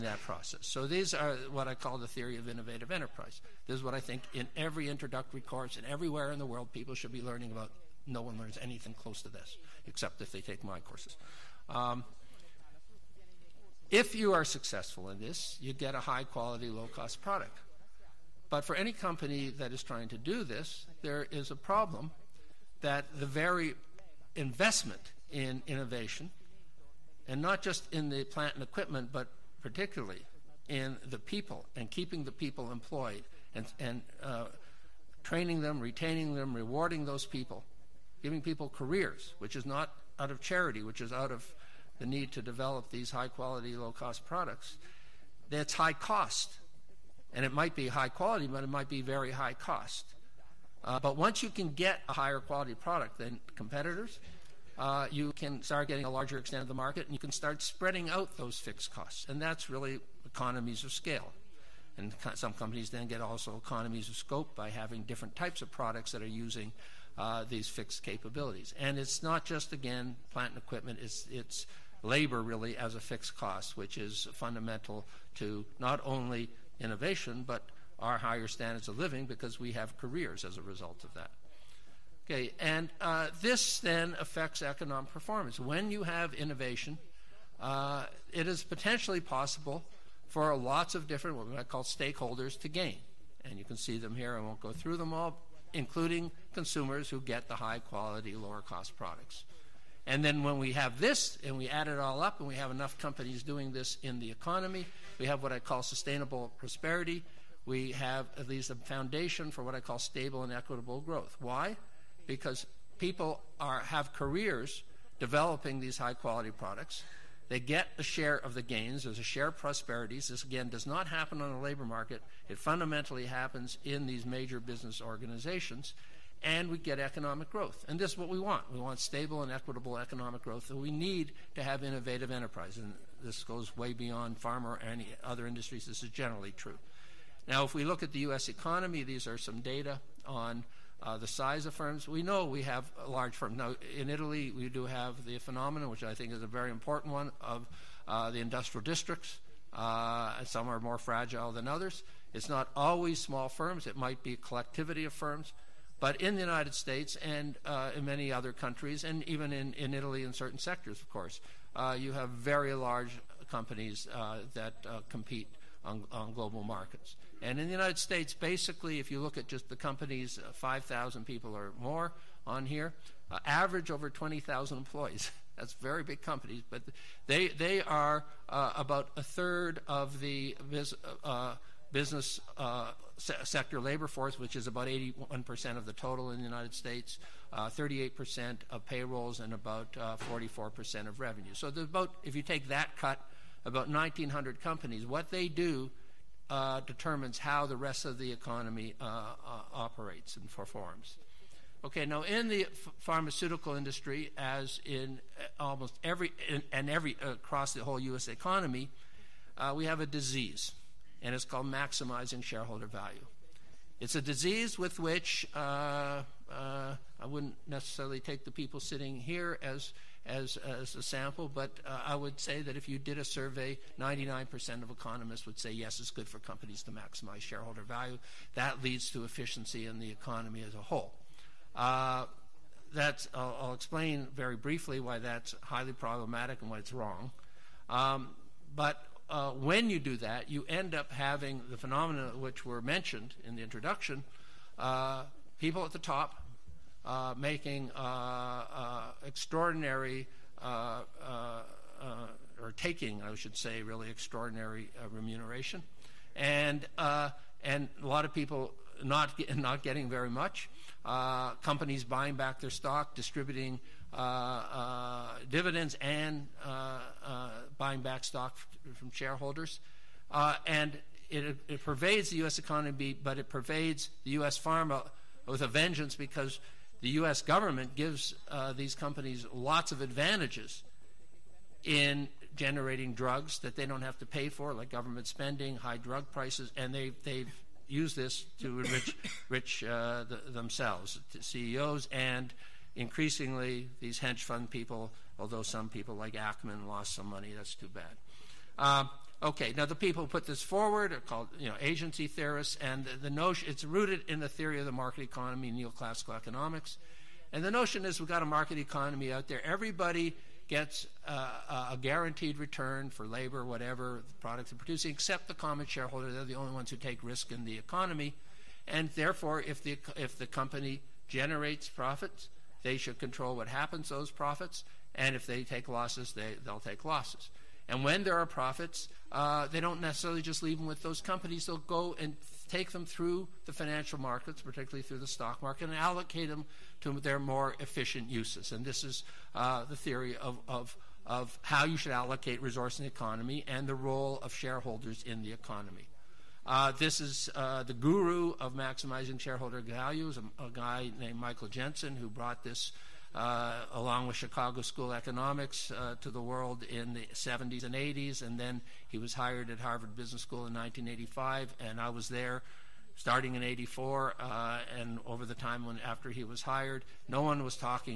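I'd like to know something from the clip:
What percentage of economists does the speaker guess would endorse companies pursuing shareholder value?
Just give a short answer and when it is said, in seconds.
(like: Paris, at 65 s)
99%, at 223 s.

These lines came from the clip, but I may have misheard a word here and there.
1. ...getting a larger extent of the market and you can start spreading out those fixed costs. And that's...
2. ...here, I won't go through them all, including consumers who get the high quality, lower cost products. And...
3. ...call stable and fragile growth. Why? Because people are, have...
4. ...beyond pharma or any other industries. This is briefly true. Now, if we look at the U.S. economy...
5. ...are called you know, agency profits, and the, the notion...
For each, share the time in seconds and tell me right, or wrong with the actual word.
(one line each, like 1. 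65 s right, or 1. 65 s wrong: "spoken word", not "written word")
1. 55 s right
2. 94 s right
3. 109 s wrong: "equitable", not "fragile"
4. 133 s wrong: "generally", not "briefly"
5. 301 s wrong: "theorists", not "profits".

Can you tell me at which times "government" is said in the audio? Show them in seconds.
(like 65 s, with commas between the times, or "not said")
277 s, 284 s.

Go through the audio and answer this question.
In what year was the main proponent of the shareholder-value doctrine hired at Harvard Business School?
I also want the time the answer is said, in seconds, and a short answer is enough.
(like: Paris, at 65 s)
1985, at 360 s.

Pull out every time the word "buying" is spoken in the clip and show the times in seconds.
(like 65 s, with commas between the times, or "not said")
262 s, 267 s.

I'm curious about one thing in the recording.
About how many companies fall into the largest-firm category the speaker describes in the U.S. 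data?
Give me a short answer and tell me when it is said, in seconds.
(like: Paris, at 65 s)
1,900, at 193 s.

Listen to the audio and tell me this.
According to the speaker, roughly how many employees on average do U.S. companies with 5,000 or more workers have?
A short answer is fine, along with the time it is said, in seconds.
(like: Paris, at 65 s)
over 20,000, at 173 s.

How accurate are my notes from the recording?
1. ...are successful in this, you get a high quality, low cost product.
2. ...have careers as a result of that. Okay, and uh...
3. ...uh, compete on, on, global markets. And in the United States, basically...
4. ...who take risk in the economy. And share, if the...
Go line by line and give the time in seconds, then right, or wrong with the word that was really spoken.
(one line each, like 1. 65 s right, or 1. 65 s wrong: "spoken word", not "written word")
1. 14 s right
2. 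79 s right
3. 164 s right
4. 316 s wrong: "therefore", not "share".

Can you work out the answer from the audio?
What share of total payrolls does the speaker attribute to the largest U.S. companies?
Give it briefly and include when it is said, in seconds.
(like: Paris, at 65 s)
38%, at 187 s.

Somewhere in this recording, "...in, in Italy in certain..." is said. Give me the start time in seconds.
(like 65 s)
159 s.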